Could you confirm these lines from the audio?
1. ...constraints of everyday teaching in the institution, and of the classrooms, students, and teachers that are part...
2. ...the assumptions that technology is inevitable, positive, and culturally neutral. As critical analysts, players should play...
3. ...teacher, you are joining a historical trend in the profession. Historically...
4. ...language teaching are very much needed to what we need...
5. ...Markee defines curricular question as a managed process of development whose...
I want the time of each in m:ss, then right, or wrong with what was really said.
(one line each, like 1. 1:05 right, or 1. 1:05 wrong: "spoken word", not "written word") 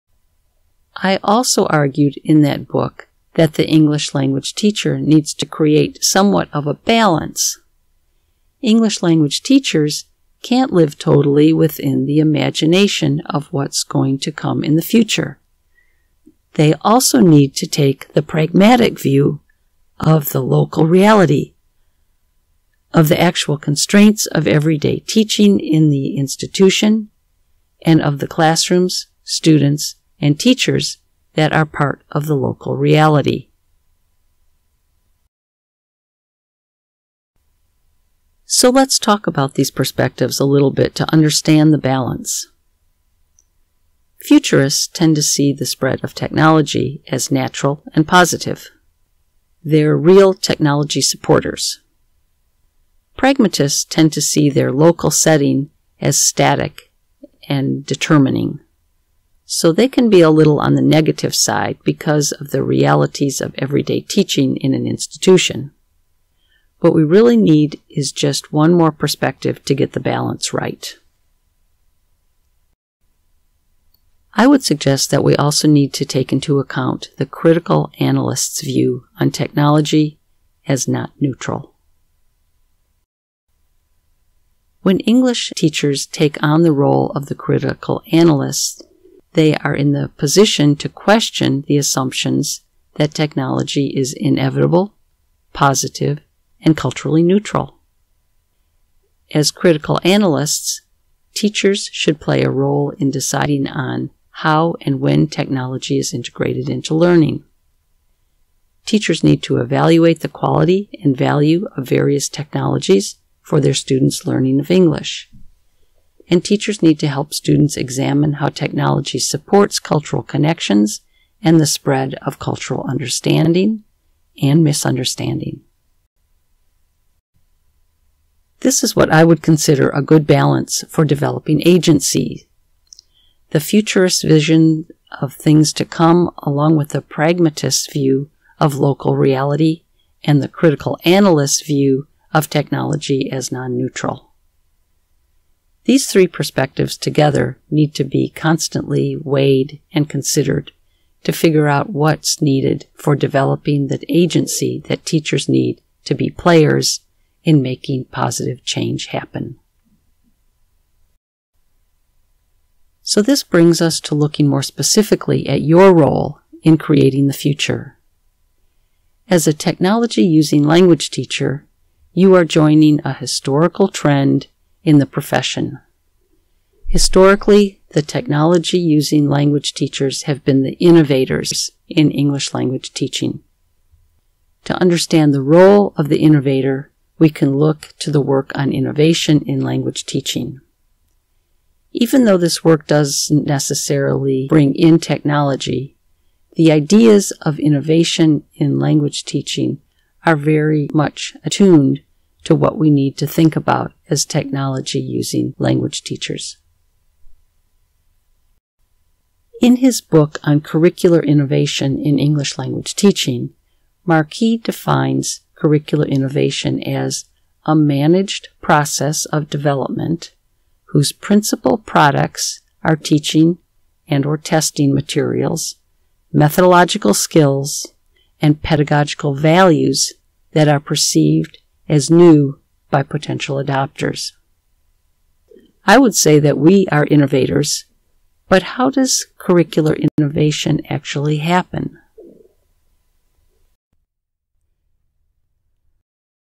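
1. 0:23 right
2. 1:31 wrong: "teachers", not "players"
3. 2:51 right
4. 3:18 wrong: "attuned", not "needed"
5. 3:34 wrong: "innovation", not "question".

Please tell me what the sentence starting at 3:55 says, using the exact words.
I would say that we are innovators, but how does curricular innovation actually happen?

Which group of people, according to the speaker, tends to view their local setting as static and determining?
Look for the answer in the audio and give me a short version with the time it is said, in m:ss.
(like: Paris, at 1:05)
Pragmatists, at 0:53.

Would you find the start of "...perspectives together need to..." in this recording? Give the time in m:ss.
2:26.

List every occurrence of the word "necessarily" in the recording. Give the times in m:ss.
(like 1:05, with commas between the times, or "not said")
3:13.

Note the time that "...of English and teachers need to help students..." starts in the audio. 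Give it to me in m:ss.
1:54.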